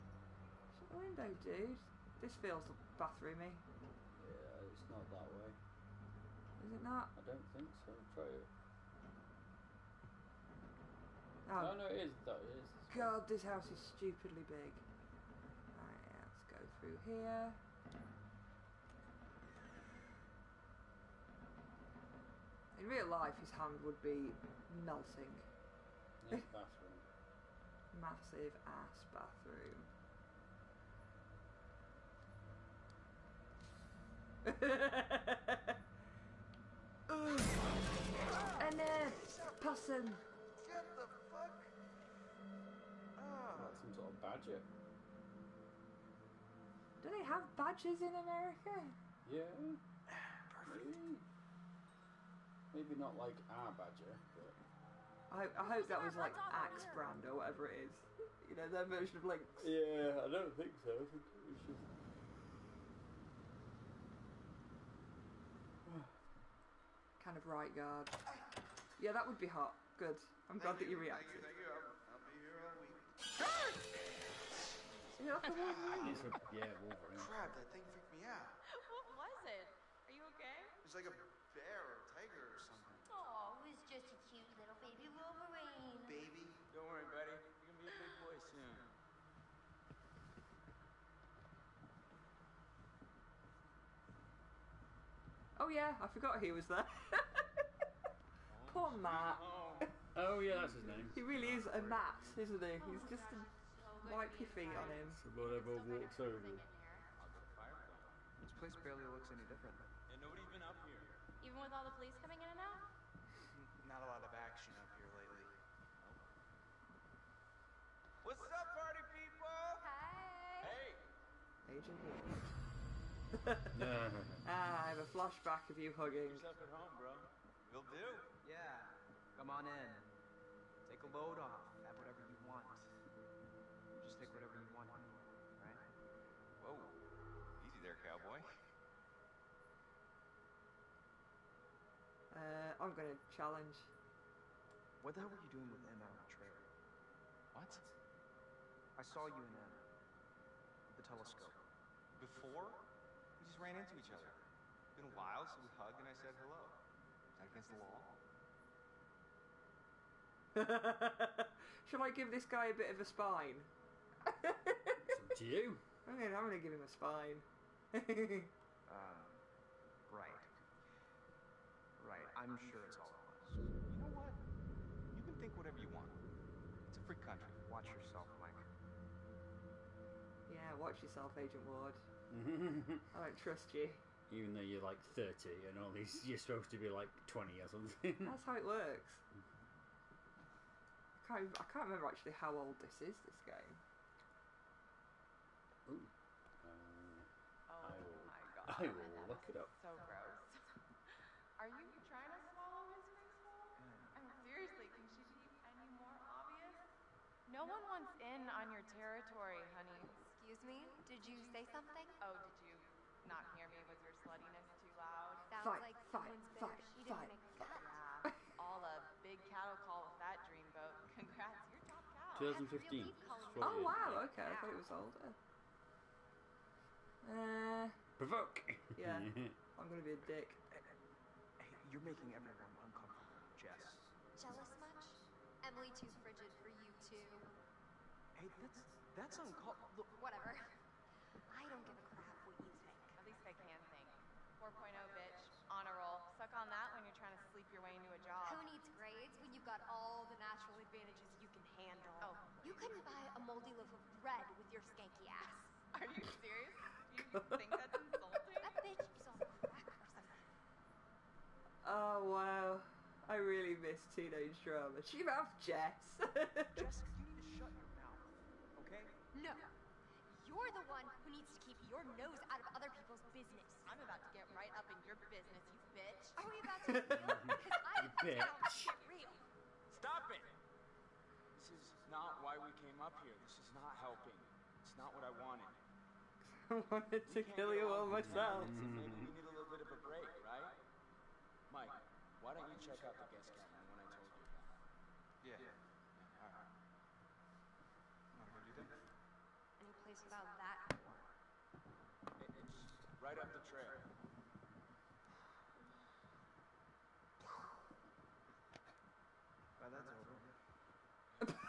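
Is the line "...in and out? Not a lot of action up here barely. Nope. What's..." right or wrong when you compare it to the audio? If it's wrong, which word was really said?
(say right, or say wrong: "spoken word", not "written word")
wrong: "lately", not "barely".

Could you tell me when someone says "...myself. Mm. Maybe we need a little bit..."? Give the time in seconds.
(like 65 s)
288 s.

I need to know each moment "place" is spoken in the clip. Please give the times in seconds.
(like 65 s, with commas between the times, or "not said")
108 s, 300 s.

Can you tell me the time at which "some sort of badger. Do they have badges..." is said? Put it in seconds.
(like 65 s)
43 s.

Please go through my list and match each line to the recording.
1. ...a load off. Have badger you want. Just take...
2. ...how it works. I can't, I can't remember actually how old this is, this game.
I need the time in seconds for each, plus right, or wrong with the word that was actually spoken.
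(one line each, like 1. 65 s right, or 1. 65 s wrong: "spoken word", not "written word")
1. 131 s wrong: "whatever", not "badger"
2. 188 s right.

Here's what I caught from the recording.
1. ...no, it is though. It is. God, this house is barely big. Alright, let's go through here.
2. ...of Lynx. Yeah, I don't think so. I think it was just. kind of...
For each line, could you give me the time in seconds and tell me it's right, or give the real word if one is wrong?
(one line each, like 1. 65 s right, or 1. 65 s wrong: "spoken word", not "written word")
1. 11 s wrong: "stupidly", not "barely"
2. 59 s right.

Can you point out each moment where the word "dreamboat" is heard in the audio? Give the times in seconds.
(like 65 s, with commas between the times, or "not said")
220 s.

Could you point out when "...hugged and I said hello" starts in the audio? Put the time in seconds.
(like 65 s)
155 s.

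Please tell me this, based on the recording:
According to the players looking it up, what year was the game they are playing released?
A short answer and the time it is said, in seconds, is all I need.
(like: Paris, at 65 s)
2015, at 222 s.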